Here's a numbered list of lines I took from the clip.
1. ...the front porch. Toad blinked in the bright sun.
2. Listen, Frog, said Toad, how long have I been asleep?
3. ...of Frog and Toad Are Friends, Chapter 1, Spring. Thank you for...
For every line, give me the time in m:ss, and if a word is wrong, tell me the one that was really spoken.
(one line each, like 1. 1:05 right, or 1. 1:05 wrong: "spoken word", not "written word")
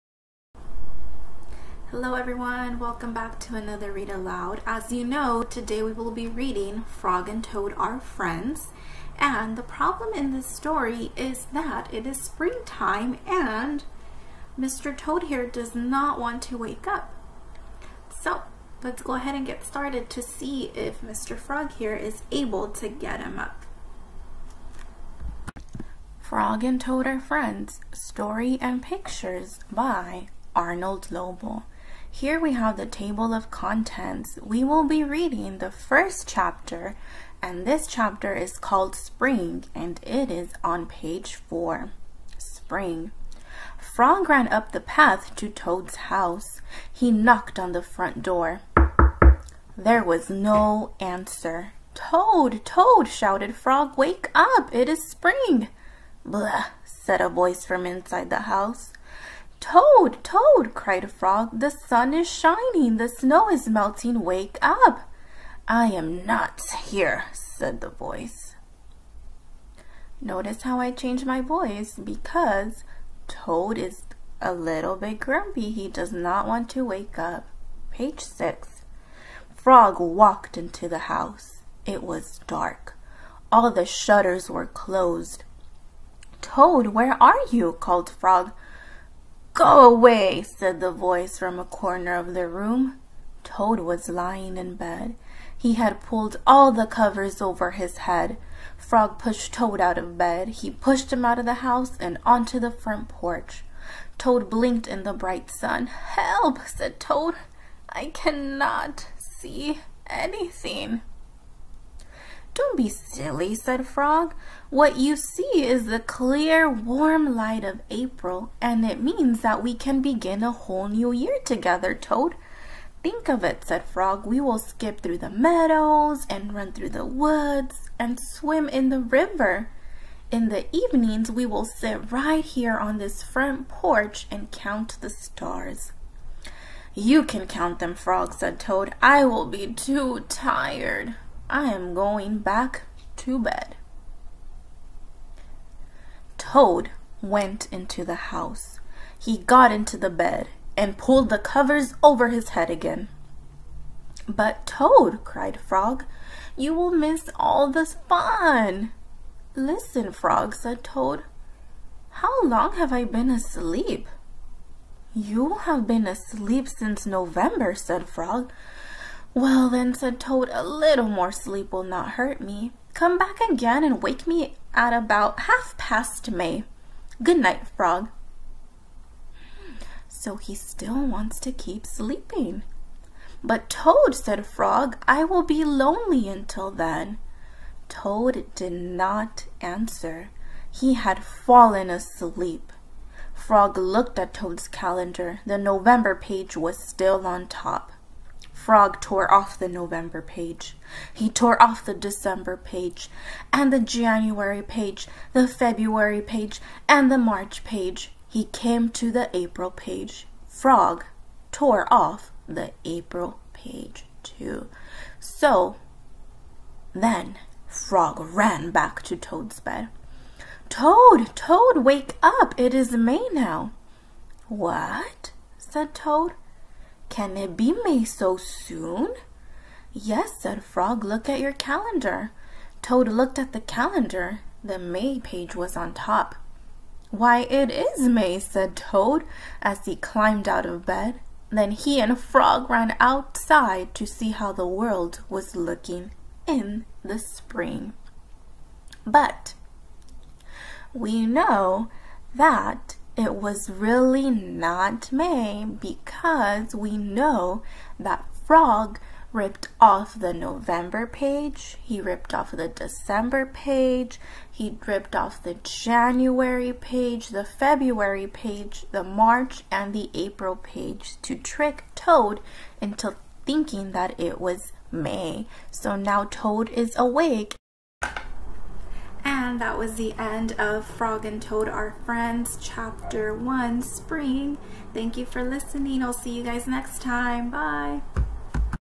1. 1:42 right
2. 2:39 right
3. 4:40 right.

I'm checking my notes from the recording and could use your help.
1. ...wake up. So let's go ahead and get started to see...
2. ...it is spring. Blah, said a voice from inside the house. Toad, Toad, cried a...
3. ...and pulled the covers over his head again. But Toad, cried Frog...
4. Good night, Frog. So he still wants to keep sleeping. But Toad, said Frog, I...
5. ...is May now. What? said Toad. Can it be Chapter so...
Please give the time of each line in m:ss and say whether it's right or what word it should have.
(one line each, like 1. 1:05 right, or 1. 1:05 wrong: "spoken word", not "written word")
1. 0:16 right
2. 0:54 right
3. 2:30 right
4. 2:57 right
5. 3:42 wrong: "May", not "Chapter".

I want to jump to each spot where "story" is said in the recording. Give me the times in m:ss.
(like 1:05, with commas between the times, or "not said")
0:10, 0:27.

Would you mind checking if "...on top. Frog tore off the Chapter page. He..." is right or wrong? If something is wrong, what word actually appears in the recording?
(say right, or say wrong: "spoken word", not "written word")
wrong: "November", not "Chapter".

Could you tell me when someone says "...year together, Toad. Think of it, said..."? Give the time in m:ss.
2:01.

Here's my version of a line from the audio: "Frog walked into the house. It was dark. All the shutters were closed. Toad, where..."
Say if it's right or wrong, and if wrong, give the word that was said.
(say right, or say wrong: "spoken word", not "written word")
right.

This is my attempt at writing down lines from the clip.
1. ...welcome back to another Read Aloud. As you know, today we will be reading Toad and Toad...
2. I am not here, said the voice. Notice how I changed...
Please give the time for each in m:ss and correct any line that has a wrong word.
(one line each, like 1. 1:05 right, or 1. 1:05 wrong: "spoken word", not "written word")
1. 0:02 wrong: "Frog", not "Toad"
2. 1:05 right.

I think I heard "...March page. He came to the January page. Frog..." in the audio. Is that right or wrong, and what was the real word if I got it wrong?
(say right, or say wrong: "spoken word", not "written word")
wrong: "April", not "January".